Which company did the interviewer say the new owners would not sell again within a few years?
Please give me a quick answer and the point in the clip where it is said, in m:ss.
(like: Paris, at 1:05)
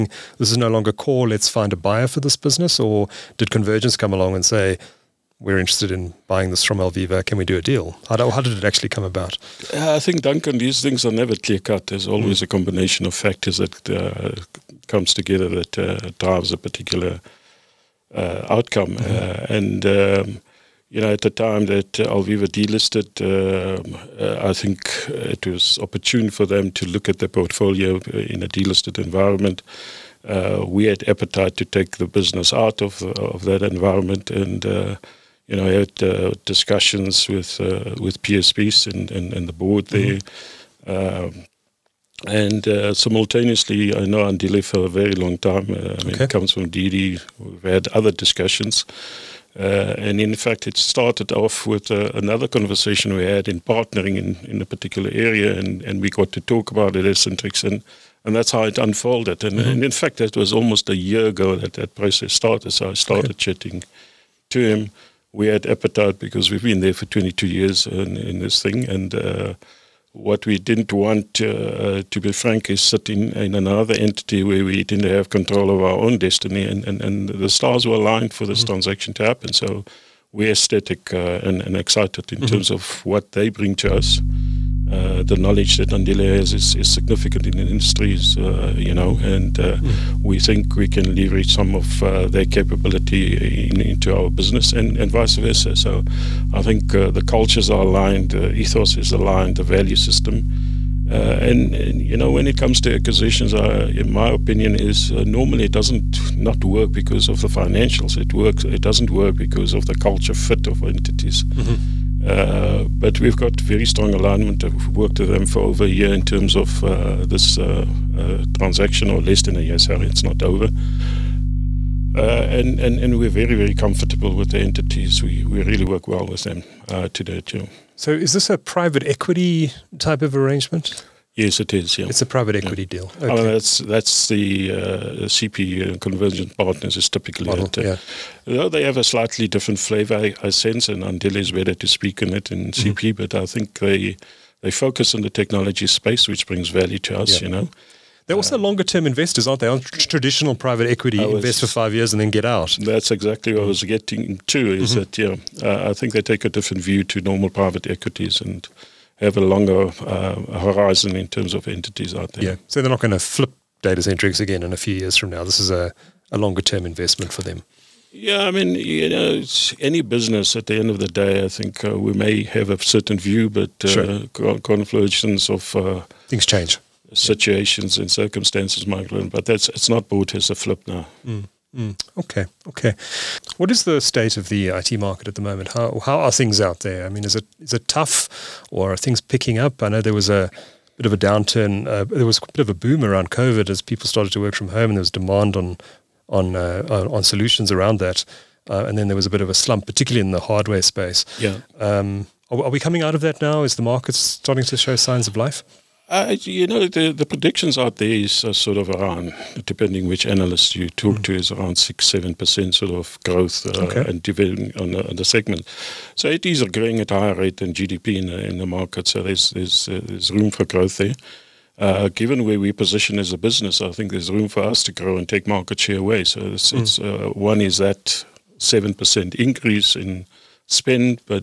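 Datacentrix, at 2:43.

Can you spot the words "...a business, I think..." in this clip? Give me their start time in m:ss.
3:43.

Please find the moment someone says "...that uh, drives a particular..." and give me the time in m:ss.
0:15.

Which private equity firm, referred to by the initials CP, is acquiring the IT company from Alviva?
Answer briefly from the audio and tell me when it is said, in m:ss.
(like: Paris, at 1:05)
Convergence Partners, at 2:15.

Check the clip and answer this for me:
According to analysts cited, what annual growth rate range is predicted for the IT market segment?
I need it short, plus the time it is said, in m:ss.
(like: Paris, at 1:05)
6-7%, at 3:31.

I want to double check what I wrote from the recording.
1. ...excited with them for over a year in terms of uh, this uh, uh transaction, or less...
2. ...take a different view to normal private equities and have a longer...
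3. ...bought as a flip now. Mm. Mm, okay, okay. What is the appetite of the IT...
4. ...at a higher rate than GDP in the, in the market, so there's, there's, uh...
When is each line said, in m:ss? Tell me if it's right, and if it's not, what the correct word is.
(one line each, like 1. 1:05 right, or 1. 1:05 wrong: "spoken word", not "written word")
1. 1:54 wrong: "worked", not "excited"
2. 2:36 right
3. 3:00 wrong: "state", not "appetite"
4. 3:36 right.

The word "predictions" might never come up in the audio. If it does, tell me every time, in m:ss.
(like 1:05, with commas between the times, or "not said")
3:27.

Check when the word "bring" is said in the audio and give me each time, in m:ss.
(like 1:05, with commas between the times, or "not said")
1:23, 2:26.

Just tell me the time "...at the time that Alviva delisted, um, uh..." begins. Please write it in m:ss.
0:21.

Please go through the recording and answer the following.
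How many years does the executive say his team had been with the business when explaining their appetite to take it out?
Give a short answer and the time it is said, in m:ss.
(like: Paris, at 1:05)
22 years, at 1:07.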